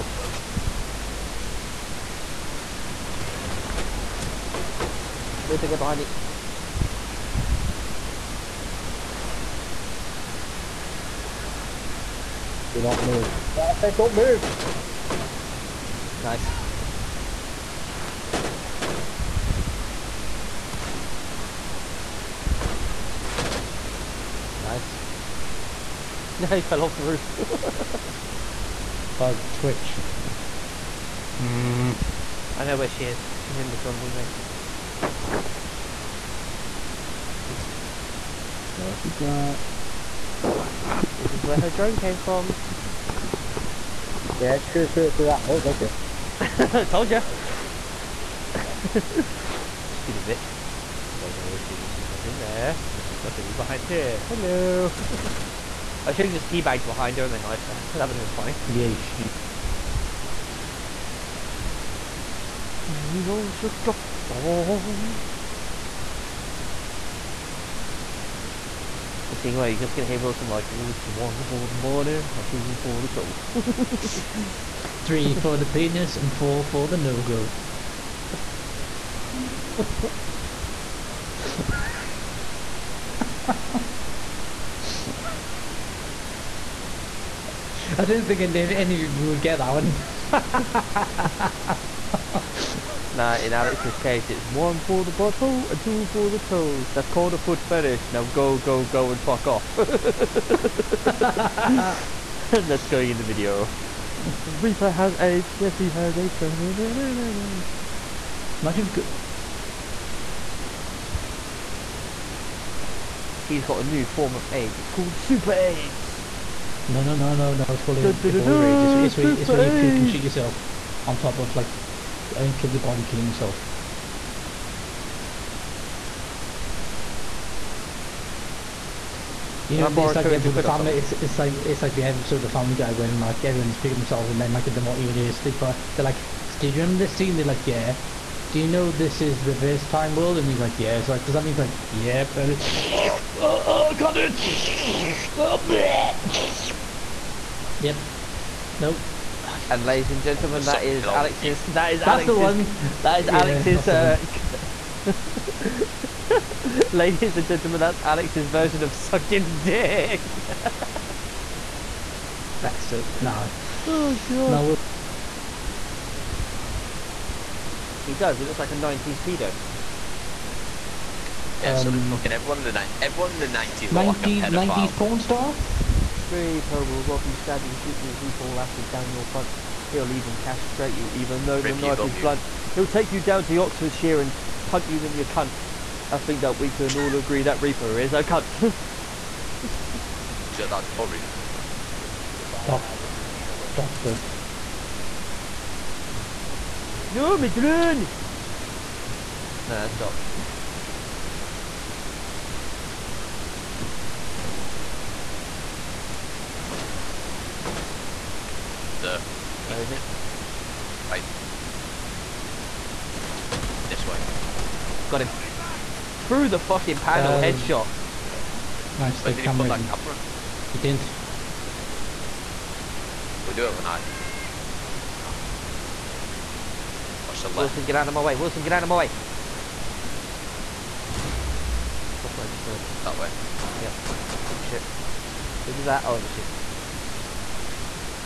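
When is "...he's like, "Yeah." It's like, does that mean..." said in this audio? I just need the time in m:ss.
2:20.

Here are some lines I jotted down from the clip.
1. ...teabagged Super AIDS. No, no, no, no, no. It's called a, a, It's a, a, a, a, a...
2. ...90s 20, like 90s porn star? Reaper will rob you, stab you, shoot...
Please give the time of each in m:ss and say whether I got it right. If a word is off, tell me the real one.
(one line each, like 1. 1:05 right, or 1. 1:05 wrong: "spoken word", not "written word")
1. 1:54 wrong: "called", not "teabagged"
2. 2:53 wrong: "90", not "20".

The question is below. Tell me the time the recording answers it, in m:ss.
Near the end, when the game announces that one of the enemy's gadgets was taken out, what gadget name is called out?
3:52.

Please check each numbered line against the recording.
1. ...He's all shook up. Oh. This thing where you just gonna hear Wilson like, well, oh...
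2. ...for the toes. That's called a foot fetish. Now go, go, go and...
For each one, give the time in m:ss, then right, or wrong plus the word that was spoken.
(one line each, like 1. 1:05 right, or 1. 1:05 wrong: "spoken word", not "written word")
1. 1:03 right
2. 1:36 right.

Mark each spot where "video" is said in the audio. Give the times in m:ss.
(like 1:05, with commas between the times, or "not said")
1:43.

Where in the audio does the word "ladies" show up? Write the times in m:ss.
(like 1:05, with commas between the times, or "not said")
2:29, 2:36.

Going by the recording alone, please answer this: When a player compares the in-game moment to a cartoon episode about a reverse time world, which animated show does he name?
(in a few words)
Family Guy.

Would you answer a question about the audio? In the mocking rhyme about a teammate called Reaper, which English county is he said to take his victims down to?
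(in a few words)
Oxfordshire.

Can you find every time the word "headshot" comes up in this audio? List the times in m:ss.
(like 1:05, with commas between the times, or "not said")
3:37.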